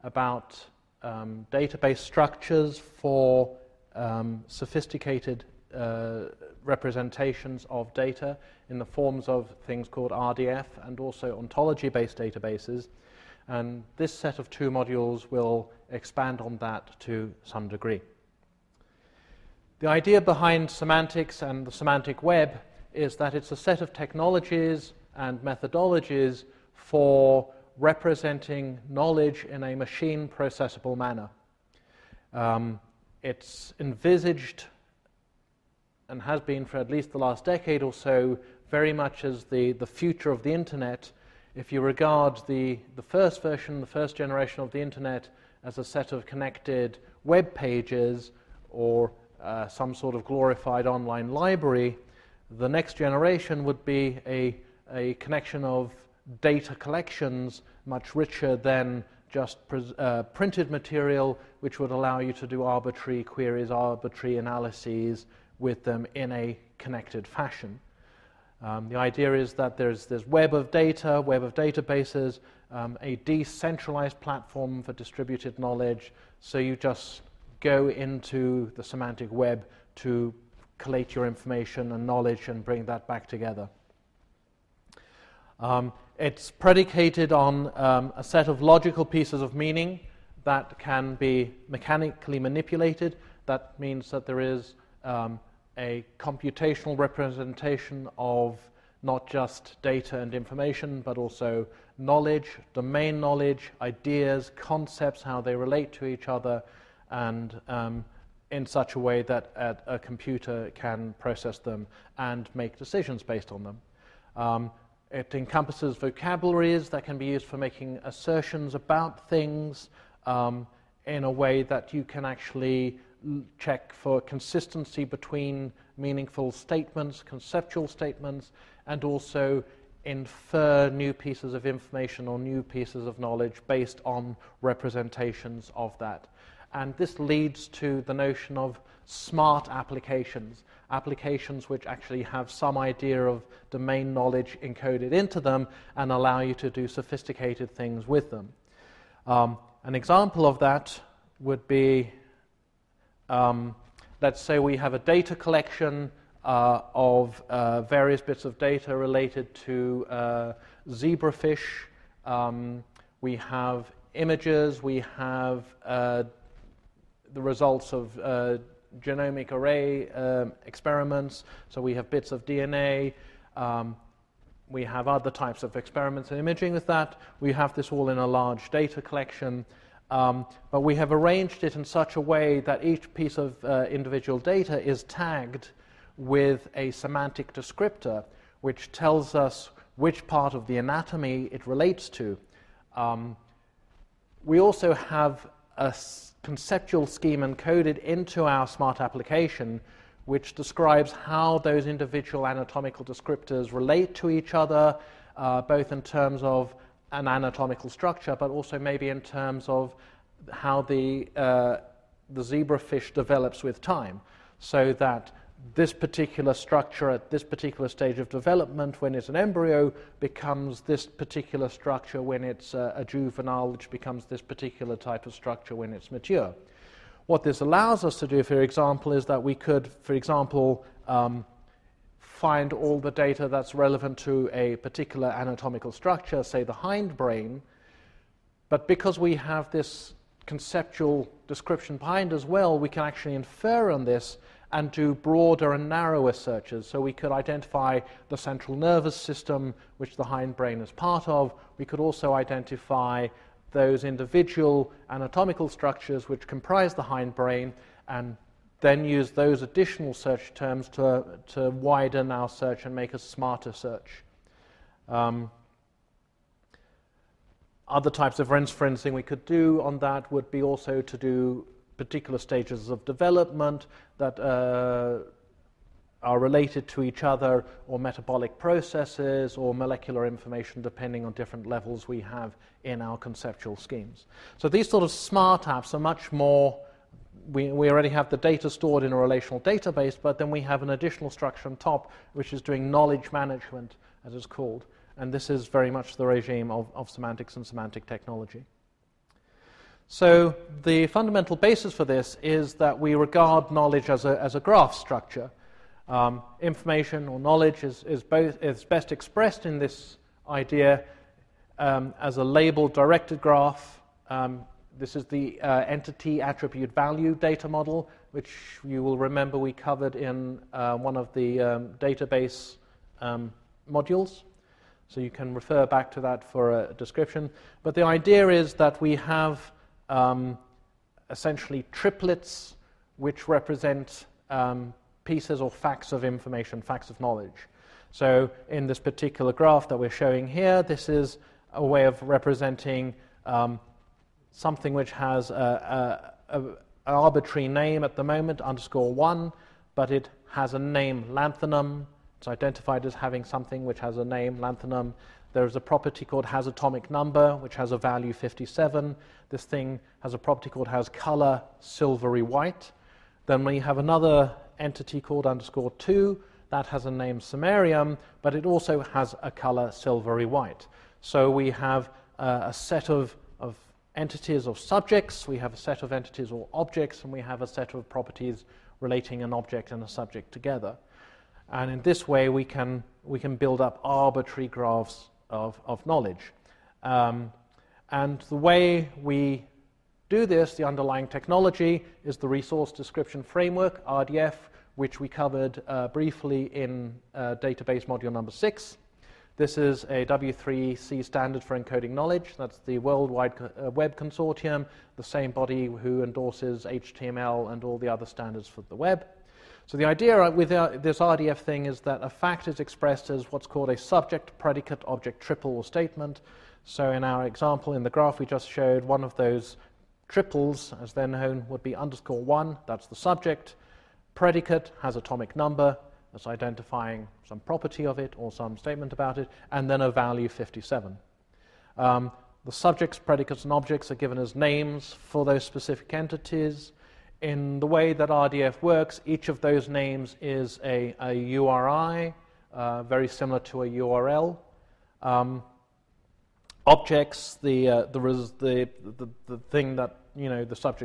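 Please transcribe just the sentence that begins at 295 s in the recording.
And this is very much the regime of, of semantics and semantic technology.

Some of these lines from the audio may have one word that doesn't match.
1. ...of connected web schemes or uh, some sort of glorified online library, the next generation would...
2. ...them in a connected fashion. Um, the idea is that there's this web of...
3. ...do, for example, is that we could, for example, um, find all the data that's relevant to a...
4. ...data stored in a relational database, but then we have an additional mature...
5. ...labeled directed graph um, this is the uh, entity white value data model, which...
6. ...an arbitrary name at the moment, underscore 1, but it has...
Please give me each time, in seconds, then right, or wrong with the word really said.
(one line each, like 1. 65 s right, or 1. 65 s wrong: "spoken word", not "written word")
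1. 46 s wrong: "pages", not "schemes"
2. 65 s right
3. 228 s right
4. 288 s wrong: "structure", not "mature"
5. 312 s wrong: "attribute", not "white"
6. 345 s right.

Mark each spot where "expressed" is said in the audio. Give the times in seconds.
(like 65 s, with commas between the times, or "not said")
309 s, 412 s.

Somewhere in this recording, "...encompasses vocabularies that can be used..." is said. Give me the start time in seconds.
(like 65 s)
115 s.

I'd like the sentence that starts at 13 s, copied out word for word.
And this set of two modules will expand on that to some degree.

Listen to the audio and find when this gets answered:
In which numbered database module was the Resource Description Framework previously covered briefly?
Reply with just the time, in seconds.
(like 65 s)
398 s.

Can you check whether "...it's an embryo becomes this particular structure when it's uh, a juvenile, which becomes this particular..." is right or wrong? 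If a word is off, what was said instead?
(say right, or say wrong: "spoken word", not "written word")
right.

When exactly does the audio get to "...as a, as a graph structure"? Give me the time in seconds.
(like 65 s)
304 s.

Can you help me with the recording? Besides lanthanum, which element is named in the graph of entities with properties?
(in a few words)
samarium.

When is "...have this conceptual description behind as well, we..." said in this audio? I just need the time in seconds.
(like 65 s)
239 s.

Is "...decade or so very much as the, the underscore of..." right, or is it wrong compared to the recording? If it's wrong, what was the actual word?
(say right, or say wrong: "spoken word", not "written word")
wrong: "future", not "underscore".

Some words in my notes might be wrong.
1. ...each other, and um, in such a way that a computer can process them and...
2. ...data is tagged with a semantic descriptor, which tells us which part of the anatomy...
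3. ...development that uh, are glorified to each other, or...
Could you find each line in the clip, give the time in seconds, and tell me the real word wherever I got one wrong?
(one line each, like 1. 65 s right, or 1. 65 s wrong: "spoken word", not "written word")
1. 106 s right
2. 184 s right
3. 273 s wrong: "related", not "glorified".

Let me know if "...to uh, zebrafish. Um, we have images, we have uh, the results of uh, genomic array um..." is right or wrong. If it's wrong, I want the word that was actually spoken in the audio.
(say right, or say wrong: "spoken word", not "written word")
right.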